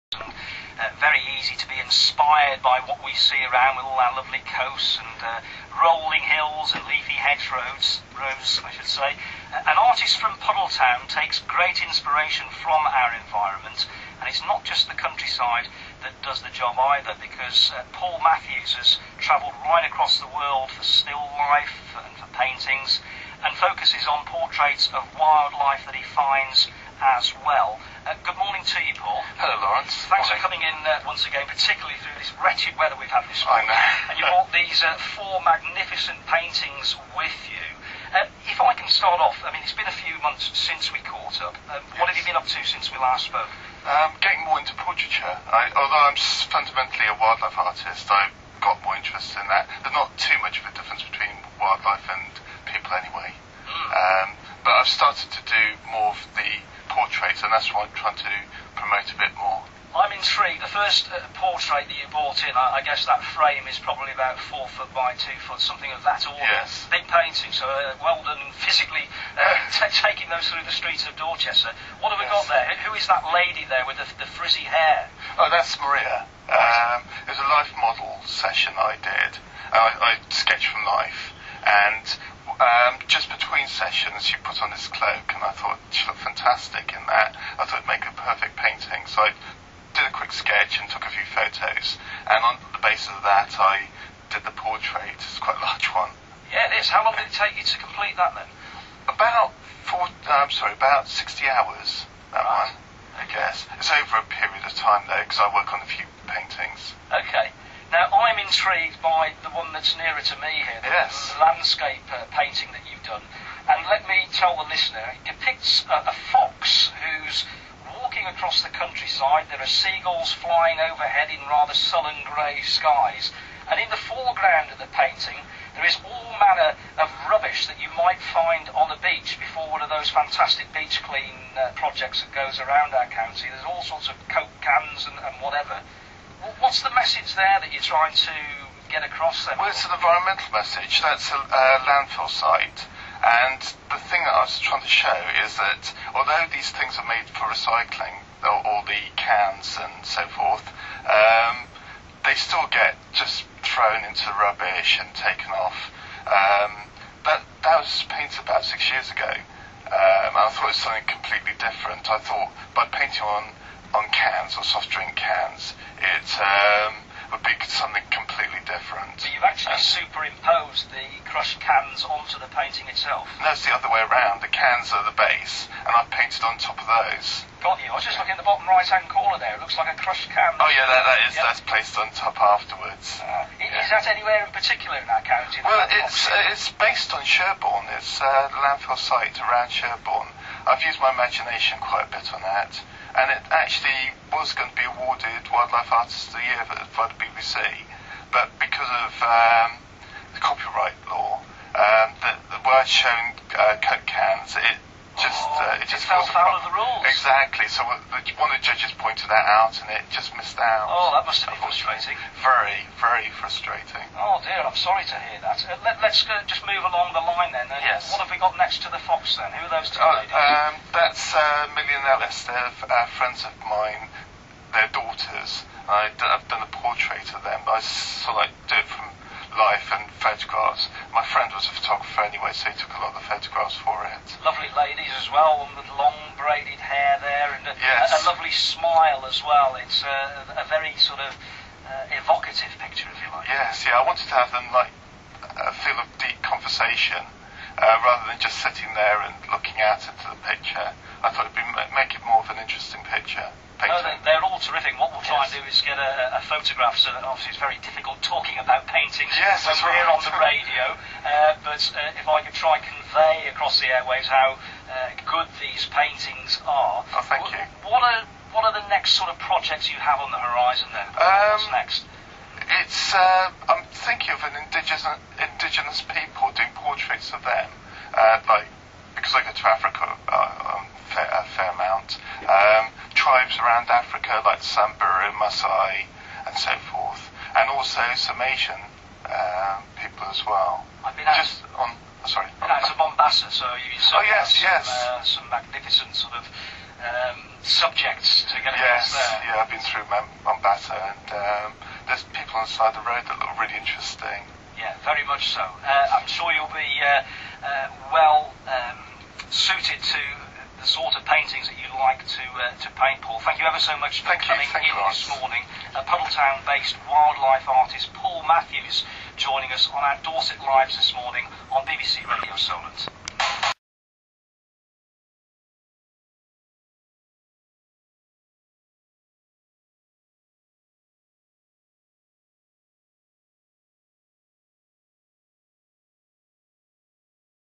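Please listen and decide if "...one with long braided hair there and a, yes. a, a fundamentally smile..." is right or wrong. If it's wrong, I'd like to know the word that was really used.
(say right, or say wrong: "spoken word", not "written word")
wrong: "lovely", not "fundamentally".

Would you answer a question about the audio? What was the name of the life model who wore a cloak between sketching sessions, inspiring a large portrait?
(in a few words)
Maria.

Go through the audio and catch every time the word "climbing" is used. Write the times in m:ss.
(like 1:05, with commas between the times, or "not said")
not said.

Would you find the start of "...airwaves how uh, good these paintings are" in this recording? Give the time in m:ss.
4:23.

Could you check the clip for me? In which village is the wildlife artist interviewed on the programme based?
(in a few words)
Puddletown.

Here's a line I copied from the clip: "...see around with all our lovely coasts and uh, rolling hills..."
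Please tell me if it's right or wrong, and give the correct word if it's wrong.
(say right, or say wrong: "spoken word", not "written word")
right.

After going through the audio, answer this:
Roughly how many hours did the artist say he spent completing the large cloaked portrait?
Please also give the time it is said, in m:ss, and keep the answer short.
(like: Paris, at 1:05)
60 hours, at 1:41.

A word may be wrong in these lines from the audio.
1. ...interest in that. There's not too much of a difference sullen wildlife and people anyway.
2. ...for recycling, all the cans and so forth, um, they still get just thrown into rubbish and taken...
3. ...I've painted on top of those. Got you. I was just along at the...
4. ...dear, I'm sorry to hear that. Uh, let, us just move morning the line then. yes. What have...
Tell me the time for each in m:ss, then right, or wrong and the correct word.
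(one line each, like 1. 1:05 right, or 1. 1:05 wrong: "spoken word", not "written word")
1. 0:48 wrong: "between", not "sullen"
2. 2:27 right
3. 2:55 wrong: "looking", not "along"
4. 3:34 wrong: "along", not "morning".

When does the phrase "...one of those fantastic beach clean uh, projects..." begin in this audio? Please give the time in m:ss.
2:09.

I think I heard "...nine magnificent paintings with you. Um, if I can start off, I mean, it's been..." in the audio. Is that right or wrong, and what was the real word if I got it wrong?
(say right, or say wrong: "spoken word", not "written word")
wrong: "four", not "nine".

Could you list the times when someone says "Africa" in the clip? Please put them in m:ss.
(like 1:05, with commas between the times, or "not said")
4:39, 4:43.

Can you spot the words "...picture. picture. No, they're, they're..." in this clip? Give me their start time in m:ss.
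4:13.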